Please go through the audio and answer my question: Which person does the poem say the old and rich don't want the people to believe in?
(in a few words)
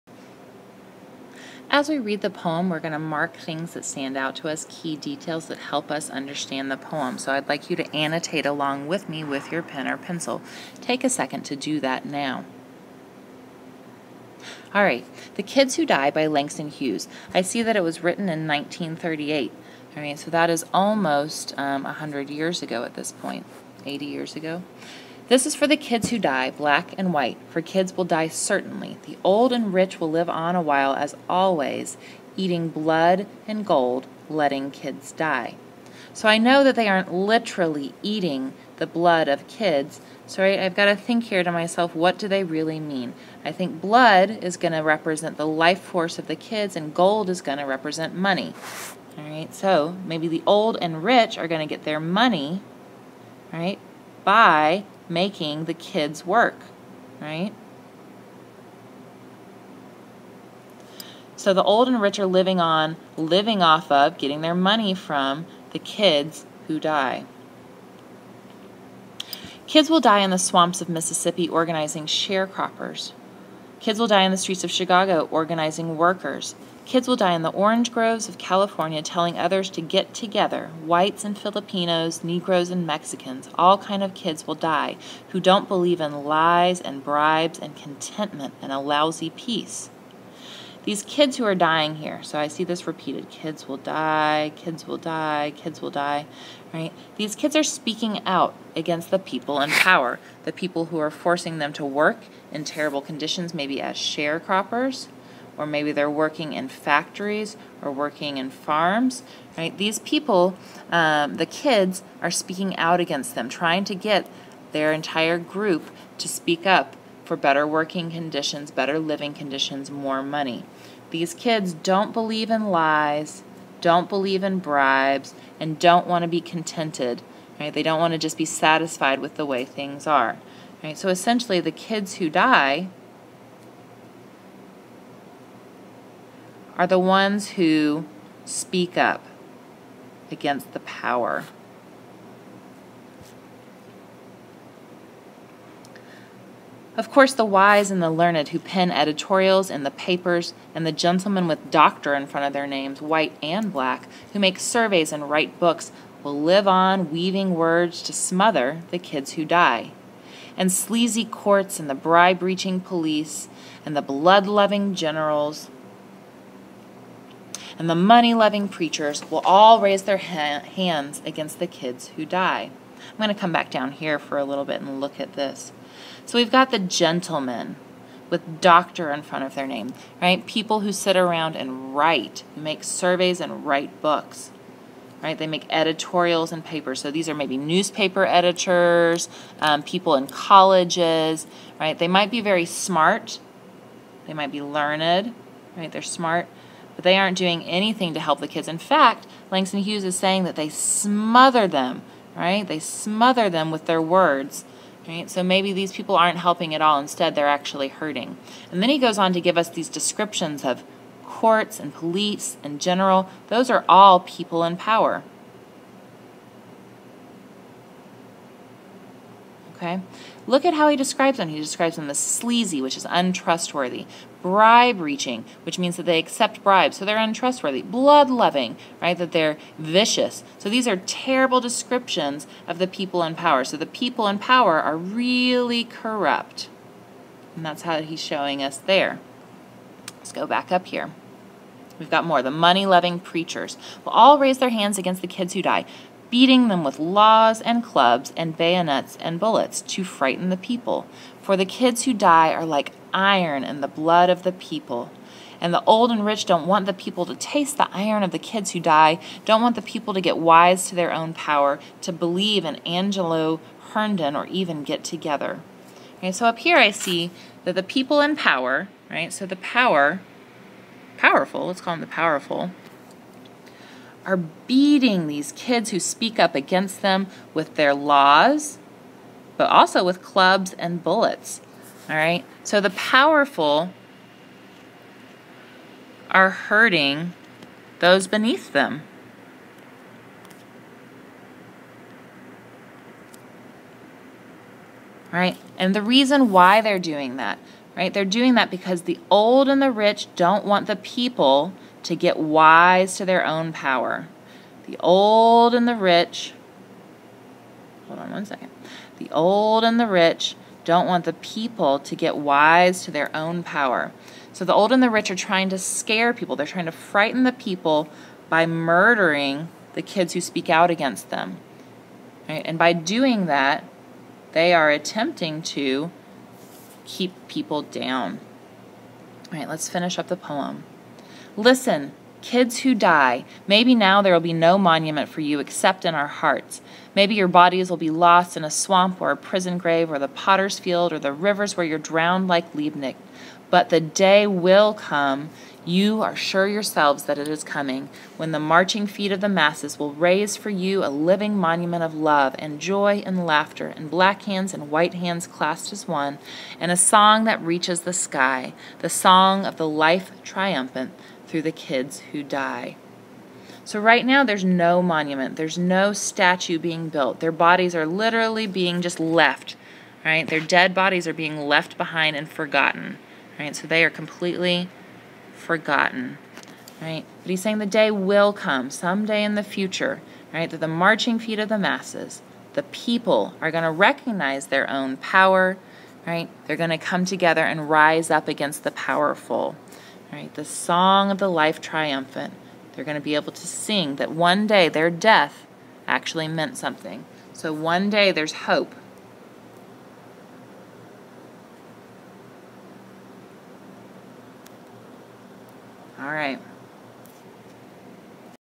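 Angelo Herndon.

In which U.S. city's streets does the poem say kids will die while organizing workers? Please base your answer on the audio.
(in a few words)
Chicago.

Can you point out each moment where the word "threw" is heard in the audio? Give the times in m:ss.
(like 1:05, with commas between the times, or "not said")
not said.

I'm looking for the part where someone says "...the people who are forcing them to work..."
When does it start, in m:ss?
1:40.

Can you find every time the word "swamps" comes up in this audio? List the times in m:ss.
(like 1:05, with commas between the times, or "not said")
1:10, 5:38.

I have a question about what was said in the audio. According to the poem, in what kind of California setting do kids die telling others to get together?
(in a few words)
orange groves.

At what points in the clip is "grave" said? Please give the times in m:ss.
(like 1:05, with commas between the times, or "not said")
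5:39.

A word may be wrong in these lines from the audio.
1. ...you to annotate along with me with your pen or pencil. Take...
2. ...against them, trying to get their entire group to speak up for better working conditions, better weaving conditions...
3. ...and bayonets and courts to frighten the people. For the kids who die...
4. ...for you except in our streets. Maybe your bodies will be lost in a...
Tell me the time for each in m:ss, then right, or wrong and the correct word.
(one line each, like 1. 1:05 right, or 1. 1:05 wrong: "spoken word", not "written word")
1. 0:07 right
2. 1:52 wrong: "living", not "weaving"
3. 4:08 wrong: "bullets", not "courts"
4. 5:35 wrong: "hearts", not "streets".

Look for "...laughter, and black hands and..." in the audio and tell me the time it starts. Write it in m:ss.
5:53.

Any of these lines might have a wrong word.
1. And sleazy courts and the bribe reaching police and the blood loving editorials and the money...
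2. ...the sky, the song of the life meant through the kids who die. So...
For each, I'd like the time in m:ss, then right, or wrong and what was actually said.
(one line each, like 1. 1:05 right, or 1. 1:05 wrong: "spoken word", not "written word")
1. 2:40 wrong: "generals", not "editorials"
2. 5:58 wrong: "triumphant", not "meant".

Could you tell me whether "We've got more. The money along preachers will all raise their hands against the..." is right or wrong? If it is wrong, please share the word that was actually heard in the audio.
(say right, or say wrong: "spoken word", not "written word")
wrong: "loving", not "along".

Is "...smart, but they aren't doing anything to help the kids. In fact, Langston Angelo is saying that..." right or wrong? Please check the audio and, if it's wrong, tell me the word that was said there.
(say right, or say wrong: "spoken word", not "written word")
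wrong: "Hughes", not "Angelo".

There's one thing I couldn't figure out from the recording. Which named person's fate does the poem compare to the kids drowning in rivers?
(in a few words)
Liebknecht.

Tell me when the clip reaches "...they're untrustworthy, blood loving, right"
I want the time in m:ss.
3:47.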